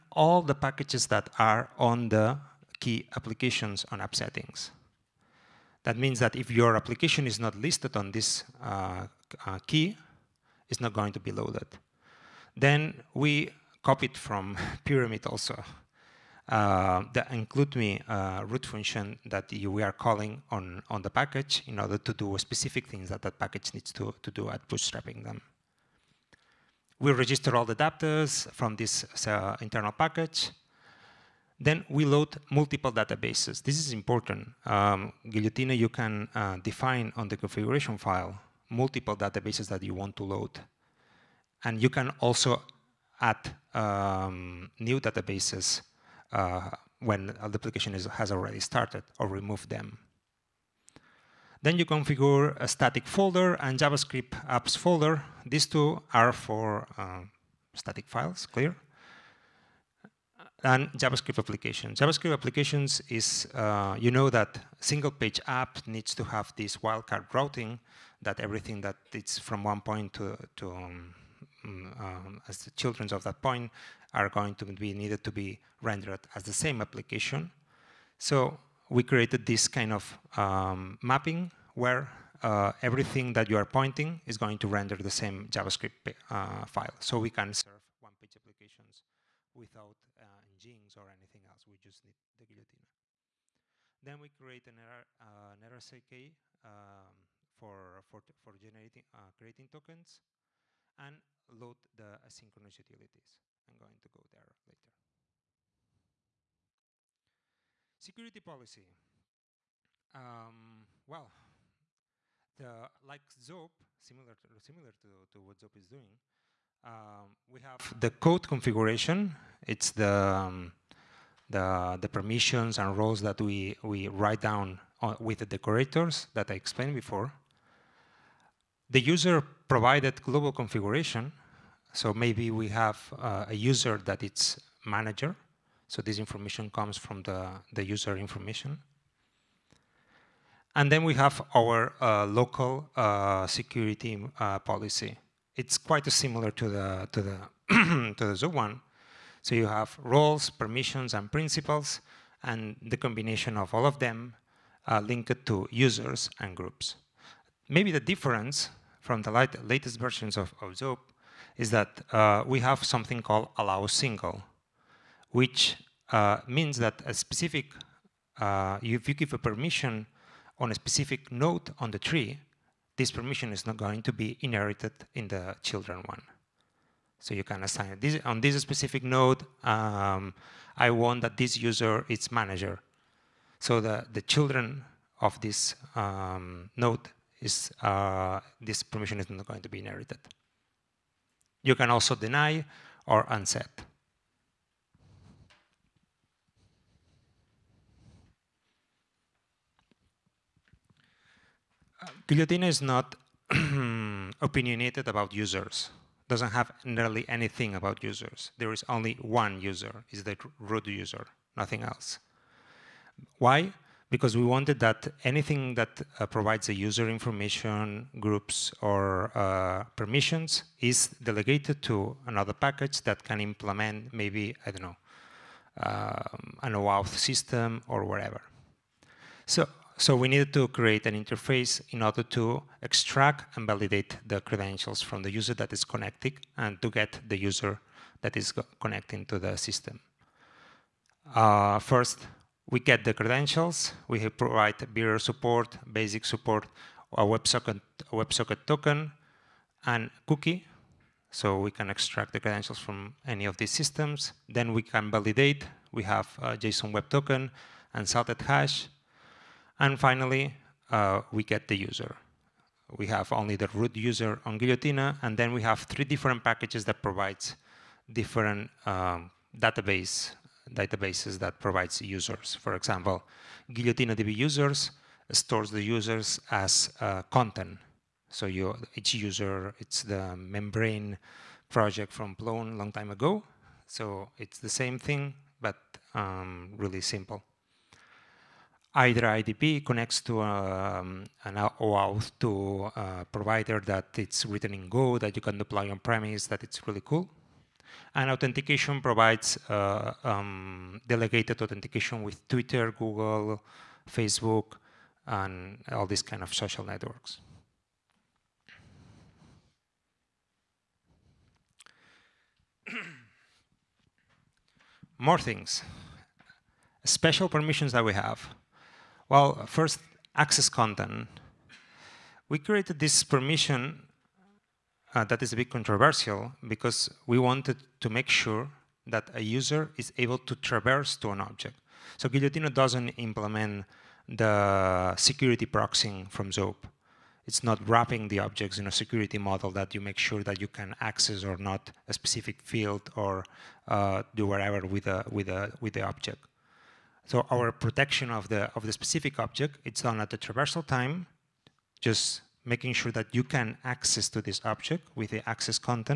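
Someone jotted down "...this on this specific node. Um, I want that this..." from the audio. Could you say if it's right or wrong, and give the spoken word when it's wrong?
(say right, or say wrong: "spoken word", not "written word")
right.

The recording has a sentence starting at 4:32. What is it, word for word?
For example, GuillotinaDB users stores the users as uh, content.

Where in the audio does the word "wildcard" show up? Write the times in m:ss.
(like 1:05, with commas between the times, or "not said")
1:06.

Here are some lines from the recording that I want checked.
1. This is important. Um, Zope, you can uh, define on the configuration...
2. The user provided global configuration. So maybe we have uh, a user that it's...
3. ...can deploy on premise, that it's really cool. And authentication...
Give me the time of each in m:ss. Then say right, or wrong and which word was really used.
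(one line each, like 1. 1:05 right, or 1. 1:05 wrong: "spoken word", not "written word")
1. 0:33 wrong: "Guillotina", not "Zope"
2. 2:08 right
3. 4:55 right.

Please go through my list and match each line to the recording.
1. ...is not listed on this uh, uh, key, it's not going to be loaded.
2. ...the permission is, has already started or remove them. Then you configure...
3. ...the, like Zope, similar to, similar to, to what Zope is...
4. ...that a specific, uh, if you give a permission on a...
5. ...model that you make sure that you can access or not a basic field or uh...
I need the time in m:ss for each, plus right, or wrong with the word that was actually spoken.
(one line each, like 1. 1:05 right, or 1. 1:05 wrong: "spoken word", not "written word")
1. 0:07 right
2. 0:47 wrong: "application", not "permission"
3. 1:52 right
4. 2:46 right
5. 5:39 wrong: "specific", not "basic".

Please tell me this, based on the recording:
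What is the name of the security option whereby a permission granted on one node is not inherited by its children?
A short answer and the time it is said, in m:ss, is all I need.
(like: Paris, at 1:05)
allow single, at 2:43.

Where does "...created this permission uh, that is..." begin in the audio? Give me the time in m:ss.
5:22.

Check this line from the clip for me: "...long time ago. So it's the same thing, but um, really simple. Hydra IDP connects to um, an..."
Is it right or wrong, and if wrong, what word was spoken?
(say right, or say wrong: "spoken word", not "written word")
right.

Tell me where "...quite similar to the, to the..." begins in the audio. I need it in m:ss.
2:25.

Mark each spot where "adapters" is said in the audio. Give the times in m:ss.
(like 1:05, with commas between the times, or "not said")
0:27.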